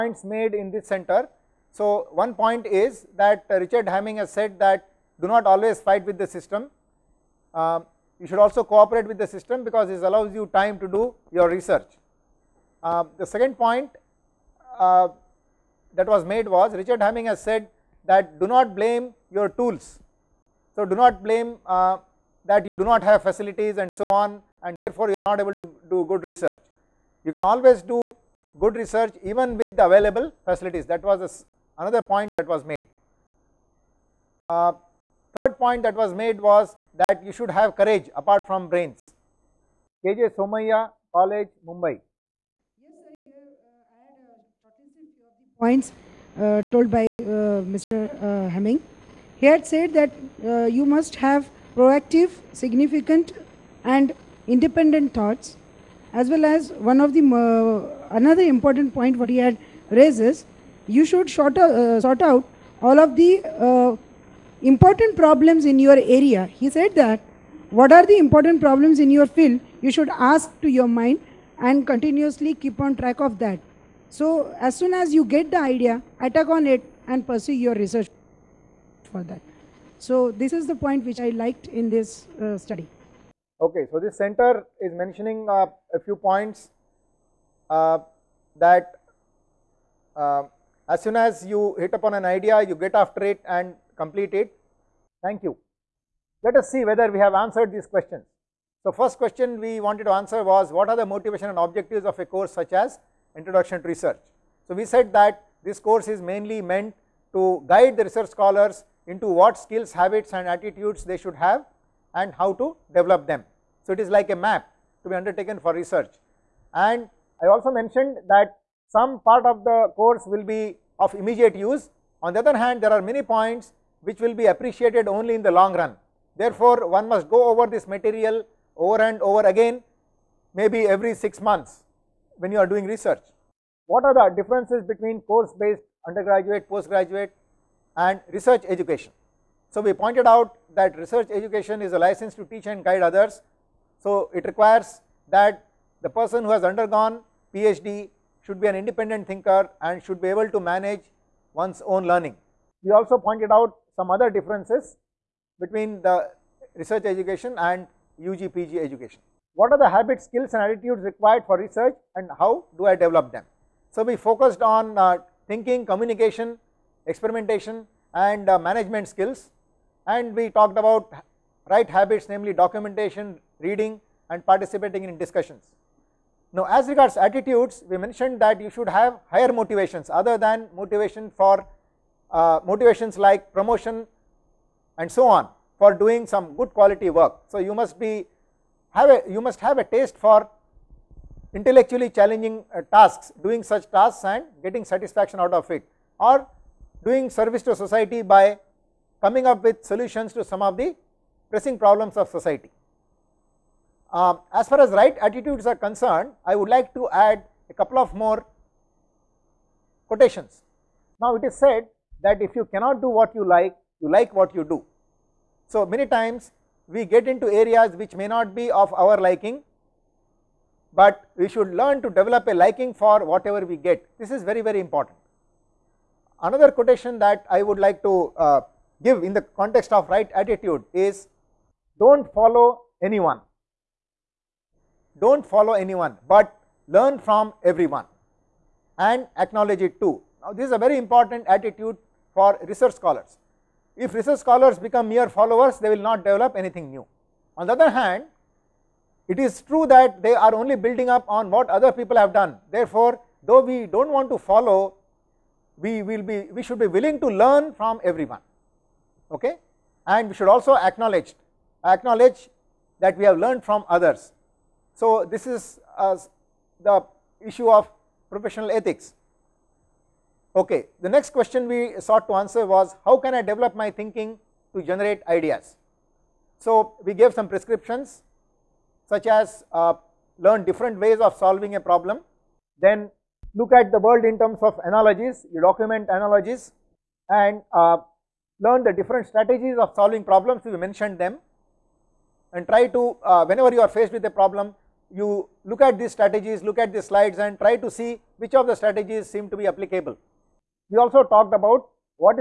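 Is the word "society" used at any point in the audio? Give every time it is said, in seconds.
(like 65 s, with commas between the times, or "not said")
197 s, 202 s.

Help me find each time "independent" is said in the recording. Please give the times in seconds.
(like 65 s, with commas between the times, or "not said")
54 s, 148 s.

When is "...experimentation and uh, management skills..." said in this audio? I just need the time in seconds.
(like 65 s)
167 s.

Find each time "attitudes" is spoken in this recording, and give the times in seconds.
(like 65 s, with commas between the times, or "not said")
110 s, 160 s, 177 s, 205 s, 230 s, 241 s.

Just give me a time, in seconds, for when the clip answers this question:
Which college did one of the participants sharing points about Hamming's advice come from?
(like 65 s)
40 s.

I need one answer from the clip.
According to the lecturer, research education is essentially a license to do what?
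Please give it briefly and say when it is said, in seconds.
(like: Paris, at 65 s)
teach and guide others, at 142 s.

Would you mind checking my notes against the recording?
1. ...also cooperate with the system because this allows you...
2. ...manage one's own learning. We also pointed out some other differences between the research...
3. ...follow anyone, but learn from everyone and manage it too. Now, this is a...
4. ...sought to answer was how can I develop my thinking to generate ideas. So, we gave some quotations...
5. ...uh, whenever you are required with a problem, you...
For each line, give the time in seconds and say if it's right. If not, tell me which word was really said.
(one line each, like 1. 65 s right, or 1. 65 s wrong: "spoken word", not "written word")
1. 8 s right
2. 150 s right
3. 235 s wrong: "acknowledge", not "manage"
4. 272 s wrong: "prescriptions", not "quotations"
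5. 293 s wrong: "faced", not "required".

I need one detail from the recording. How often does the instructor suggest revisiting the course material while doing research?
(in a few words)
every 6 months.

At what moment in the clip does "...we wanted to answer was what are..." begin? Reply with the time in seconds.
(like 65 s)
99 s.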